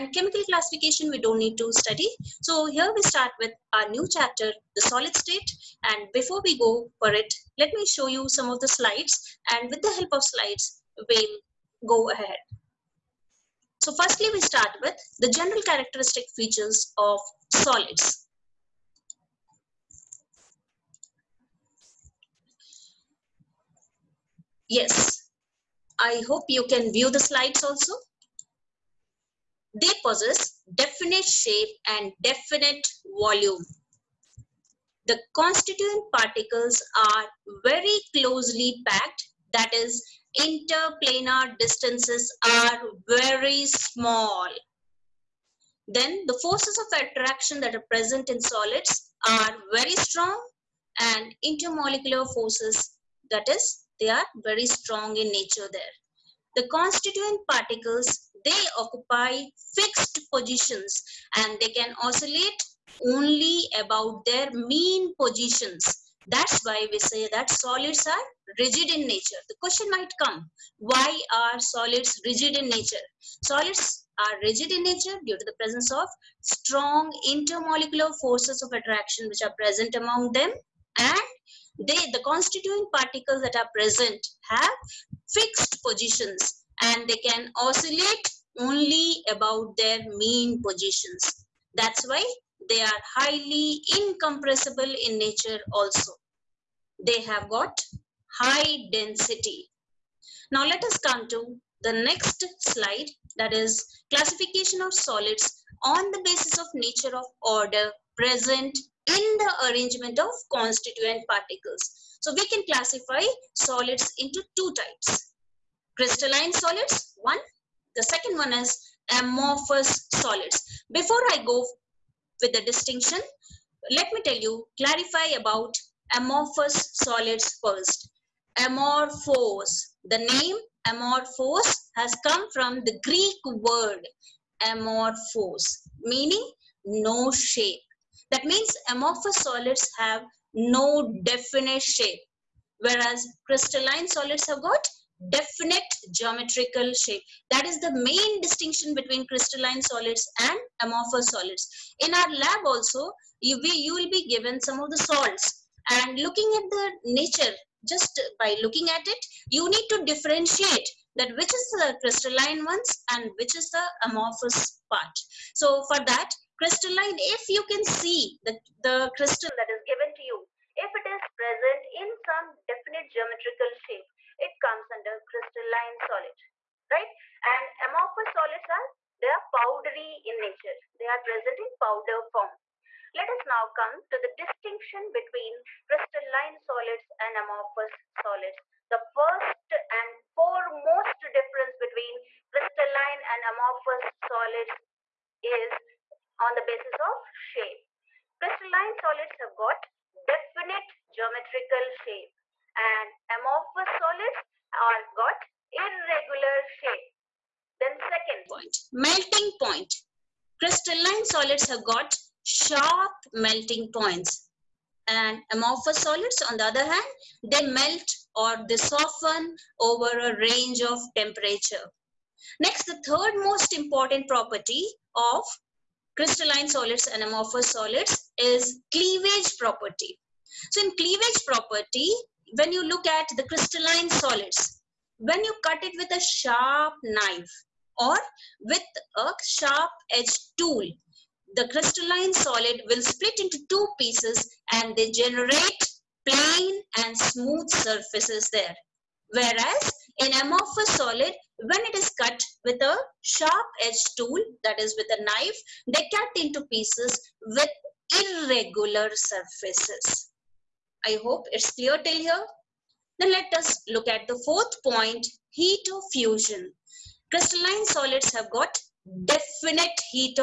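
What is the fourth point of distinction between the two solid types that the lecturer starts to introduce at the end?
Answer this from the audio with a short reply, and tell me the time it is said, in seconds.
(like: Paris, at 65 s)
heat of fusion, at 265 s.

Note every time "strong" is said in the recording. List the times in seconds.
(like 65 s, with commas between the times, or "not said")
49 s, 54 s, 76 s.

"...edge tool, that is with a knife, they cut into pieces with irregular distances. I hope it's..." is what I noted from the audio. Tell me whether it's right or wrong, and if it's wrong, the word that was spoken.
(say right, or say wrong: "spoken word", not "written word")
wrong: "surfaces", not "distances".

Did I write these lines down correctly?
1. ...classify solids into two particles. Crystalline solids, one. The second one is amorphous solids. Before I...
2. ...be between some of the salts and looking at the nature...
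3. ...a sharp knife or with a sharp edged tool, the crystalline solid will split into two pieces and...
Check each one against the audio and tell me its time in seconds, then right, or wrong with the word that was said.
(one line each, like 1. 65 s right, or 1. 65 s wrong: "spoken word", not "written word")
1. 112 s wrong: "types", not "particles"
2. 154 s wrong: "given", not "between"
3. 236 s right.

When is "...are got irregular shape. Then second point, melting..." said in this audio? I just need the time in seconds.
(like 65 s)
204 s.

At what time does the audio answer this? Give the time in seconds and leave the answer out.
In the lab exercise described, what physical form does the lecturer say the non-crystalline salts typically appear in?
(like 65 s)
181 s.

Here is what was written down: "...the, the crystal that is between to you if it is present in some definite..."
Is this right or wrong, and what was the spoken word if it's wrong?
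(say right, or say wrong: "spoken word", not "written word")
wrong: "given", not "between".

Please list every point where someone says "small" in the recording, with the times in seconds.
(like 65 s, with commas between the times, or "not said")
43 s.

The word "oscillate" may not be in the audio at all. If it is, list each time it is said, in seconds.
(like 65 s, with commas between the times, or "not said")
62 s, 87 s.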